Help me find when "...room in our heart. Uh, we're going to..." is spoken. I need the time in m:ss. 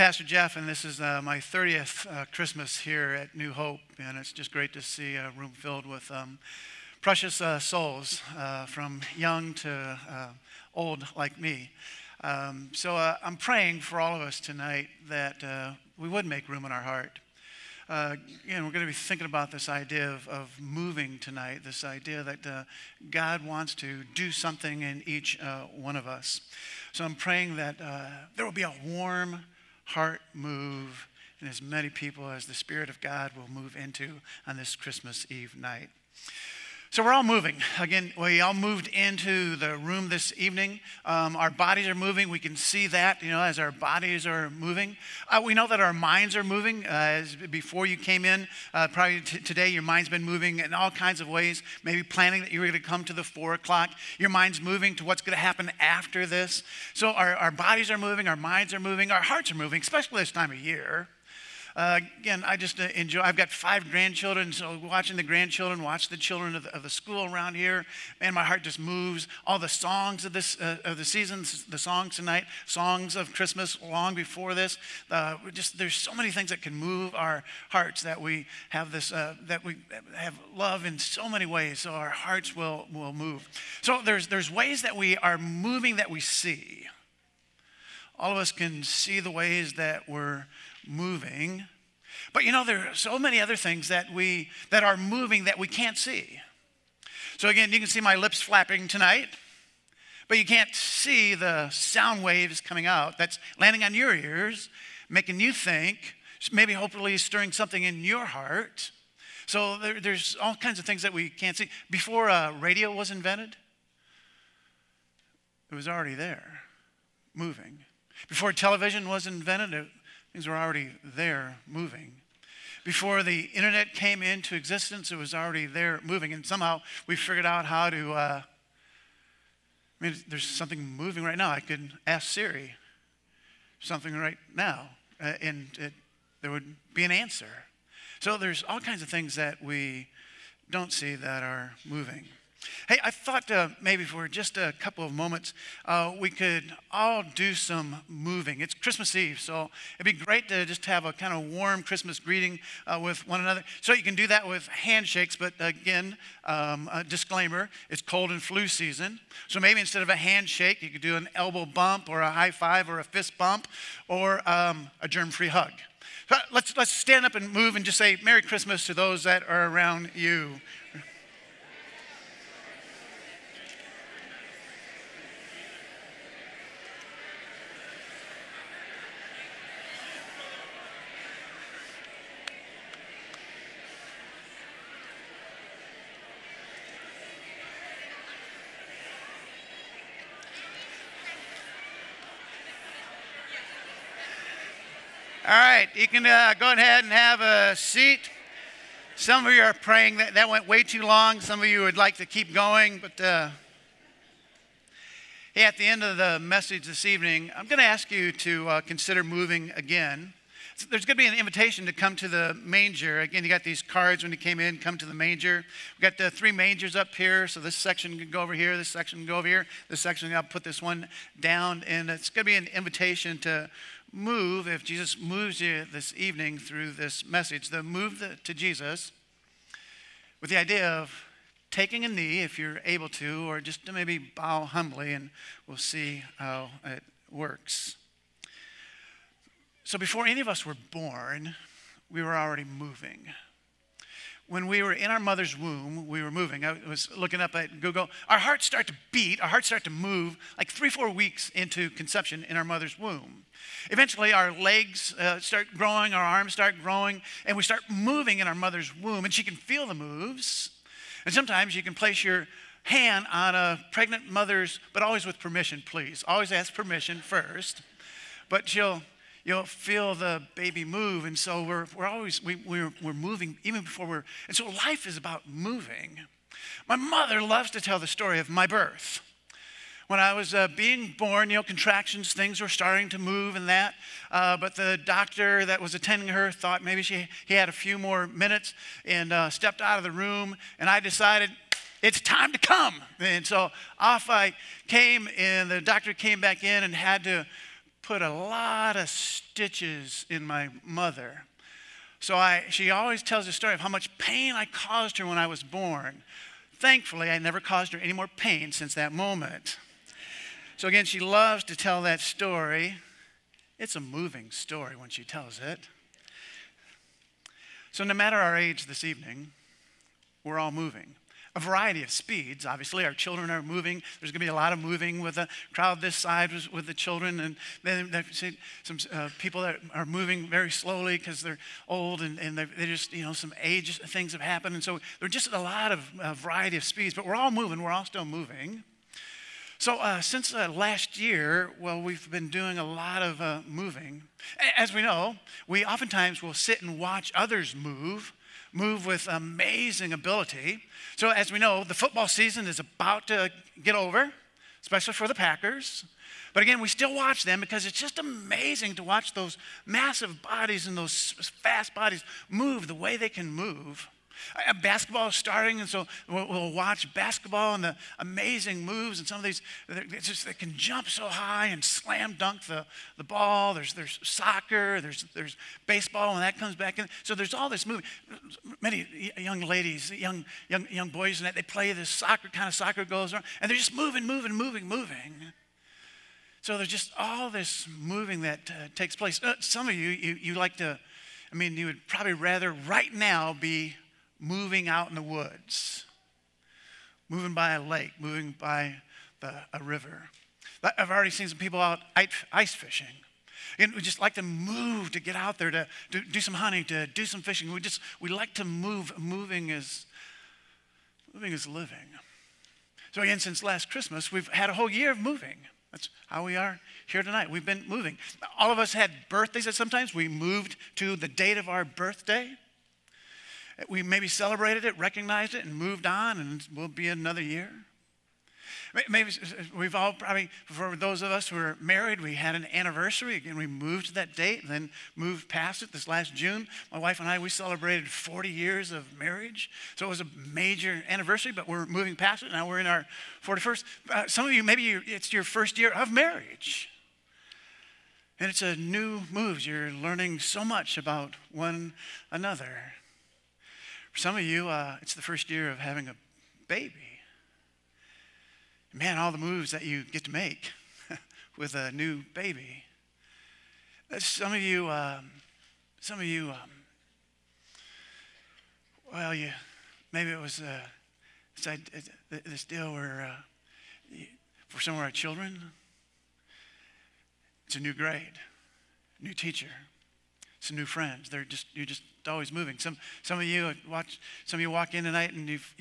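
0:16.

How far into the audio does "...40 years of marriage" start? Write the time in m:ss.
7:18.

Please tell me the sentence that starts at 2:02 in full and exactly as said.
Before the internet came into existence, it was already there moving.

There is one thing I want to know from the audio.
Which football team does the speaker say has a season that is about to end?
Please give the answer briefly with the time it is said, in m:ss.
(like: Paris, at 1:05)
Packers, at 5:55.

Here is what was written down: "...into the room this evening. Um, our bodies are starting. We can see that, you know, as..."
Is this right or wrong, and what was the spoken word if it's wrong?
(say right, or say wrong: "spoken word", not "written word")
wrong: "moving", not "starting".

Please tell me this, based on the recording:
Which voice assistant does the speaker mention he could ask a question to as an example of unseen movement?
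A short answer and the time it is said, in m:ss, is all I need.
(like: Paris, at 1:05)
Siri, at 2:12.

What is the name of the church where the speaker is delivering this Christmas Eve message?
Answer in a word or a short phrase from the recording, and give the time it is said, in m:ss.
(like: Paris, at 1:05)
New Hope, at 0:03.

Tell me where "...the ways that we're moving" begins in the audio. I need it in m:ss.
1:29.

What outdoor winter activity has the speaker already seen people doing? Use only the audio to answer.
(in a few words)
Ice fishing.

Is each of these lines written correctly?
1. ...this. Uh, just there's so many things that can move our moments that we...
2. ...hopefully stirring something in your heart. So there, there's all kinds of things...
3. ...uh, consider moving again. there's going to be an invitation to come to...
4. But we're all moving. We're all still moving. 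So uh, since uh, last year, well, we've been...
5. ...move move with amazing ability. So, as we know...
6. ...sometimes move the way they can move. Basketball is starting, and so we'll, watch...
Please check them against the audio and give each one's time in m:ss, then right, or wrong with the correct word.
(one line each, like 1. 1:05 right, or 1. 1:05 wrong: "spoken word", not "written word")
1. 1:14 wrong: "hearts", not "moments"
2. 1:46 right
3. 3:28 right
4. 5:37 right
5. 5:47 right
6. 6:01 wrong: "bodies", not "sometimes".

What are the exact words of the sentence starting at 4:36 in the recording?
My mother loves to tell the story of my birth.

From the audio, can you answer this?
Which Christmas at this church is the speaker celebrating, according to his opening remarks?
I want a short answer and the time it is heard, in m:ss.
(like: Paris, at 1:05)
30th, at 0:01.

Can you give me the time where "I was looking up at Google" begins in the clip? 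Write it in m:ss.
4:06.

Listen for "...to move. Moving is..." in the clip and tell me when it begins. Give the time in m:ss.
6:48.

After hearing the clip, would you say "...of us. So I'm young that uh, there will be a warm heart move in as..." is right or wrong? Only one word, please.
wrong.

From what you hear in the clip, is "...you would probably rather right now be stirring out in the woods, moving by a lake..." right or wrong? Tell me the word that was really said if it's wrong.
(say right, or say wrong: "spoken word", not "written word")
wrong: "moving", not "stirring".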